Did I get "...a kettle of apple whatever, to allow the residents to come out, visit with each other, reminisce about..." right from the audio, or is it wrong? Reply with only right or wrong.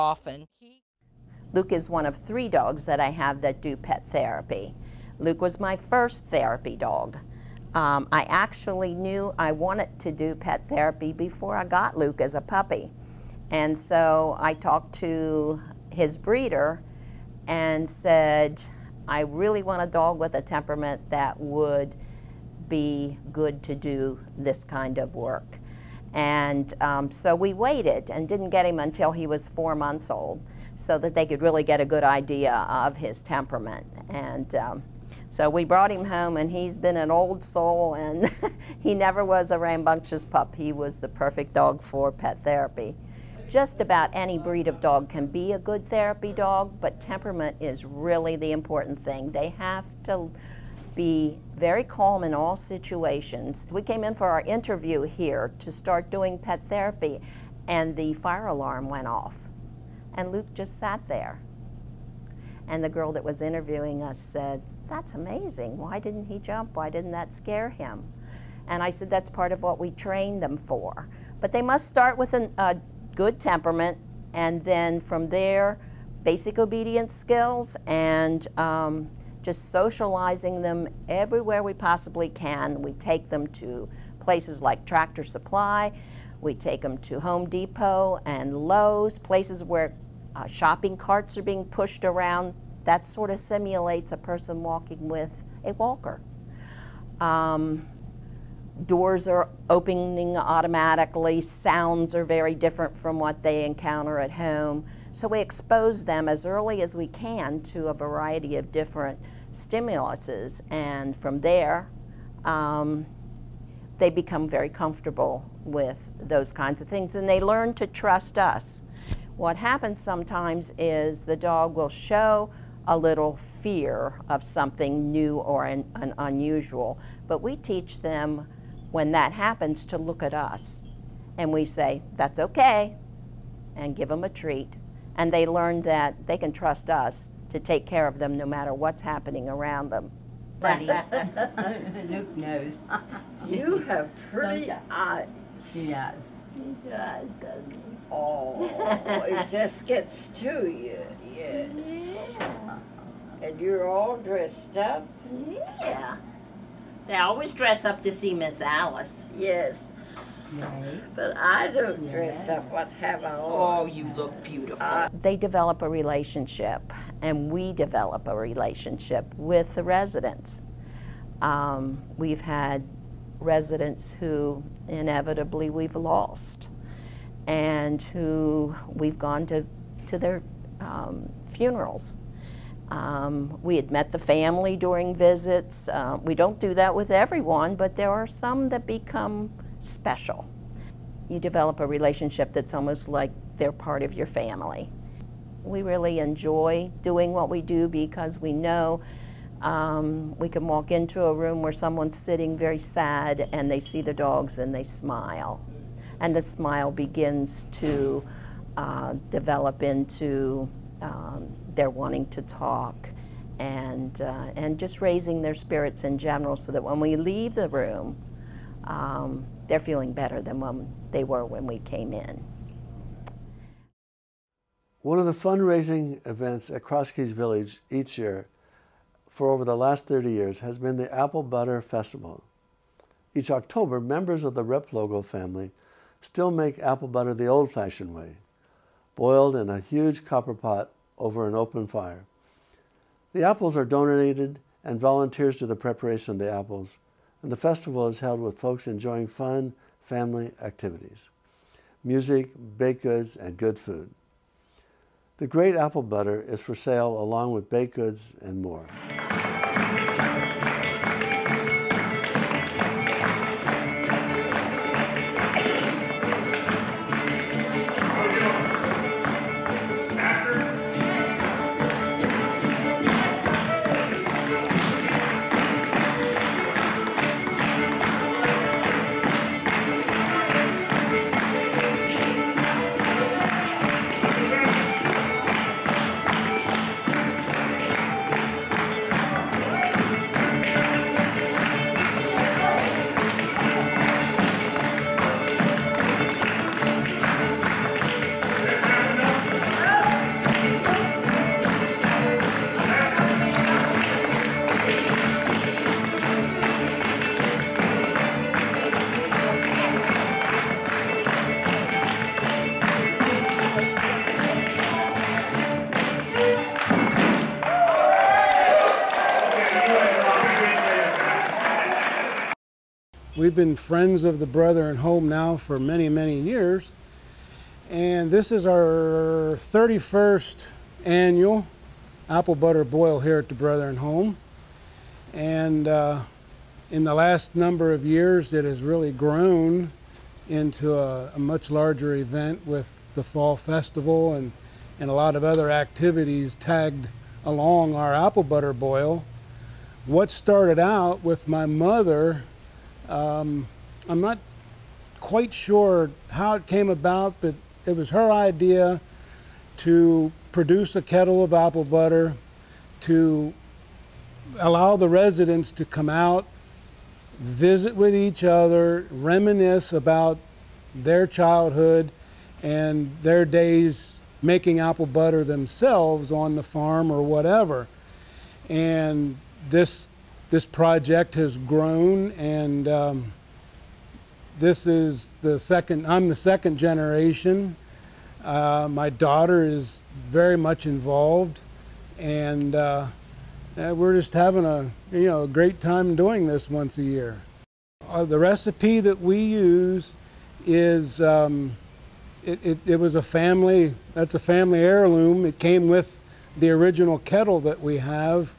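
wrong.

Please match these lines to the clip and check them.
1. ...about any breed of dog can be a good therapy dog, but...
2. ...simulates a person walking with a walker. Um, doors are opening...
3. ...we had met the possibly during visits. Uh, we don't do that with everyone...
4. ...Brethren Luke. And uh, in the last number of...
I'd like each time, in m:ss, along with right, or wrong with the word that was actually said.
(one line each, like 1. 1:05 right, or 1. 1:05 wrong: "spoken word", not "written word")
1. 0:43 right
2. 1:33 right
3. 3:03 wrong: "family", not "possibly"
4. 5:33 wrong: "Home", not "Luke".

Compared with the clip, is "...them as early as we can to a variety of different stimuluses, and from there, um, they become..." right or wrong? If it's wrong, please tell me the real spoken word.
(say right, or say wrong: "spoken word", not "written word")
right.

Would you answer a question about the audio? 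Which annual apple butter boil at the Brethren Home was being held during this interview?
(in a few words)
31st.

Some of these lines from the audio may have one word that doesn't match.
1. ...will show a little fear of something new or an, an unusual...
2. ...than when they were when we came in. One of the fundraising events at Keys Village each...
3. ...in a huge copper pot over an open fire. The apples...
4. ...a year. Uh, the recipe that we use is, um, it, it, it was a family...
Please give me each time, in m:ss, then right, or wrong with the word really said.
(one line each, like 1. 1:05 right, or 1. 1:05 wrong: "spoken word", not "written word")
1. 2:01 right
2. 3:40 right
3. 3:59 right
4. 6:36 right.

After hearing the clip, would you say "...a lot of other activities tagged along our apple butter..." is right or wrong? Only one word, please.
right.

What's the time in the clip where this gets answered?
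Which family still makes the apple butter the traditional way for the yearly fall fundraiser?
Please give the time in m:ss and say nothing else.
3:54.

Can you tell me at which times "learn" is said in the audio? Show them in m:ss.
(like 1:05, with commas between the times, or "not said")
1:57, 2:15.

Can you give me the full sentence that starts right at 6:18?
And this this project has grown and um, this is the second, I'm the second generation.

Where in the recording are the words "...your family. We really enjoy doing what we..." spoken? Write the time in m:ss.
3:14.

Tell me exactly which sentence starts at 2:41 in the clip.
But I don't dress up what have I Oh, you look beautiful.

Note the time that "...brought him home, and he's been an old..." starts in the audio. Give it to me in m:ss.
0:35.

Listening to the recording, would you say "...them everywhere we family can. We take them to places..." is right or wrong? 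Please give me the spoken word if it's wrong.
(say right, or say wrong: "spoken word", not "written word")
wrong: "possibly", not "family".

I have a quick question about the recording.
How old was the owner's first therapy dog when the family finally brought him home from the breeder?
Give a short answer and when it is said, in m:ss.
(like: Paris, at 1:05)
4 months, at 0:29.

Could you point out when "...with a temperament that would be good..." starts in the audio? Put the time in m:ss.
0:20.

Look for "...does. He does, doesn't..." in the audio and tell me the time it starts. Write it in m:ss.
2:25.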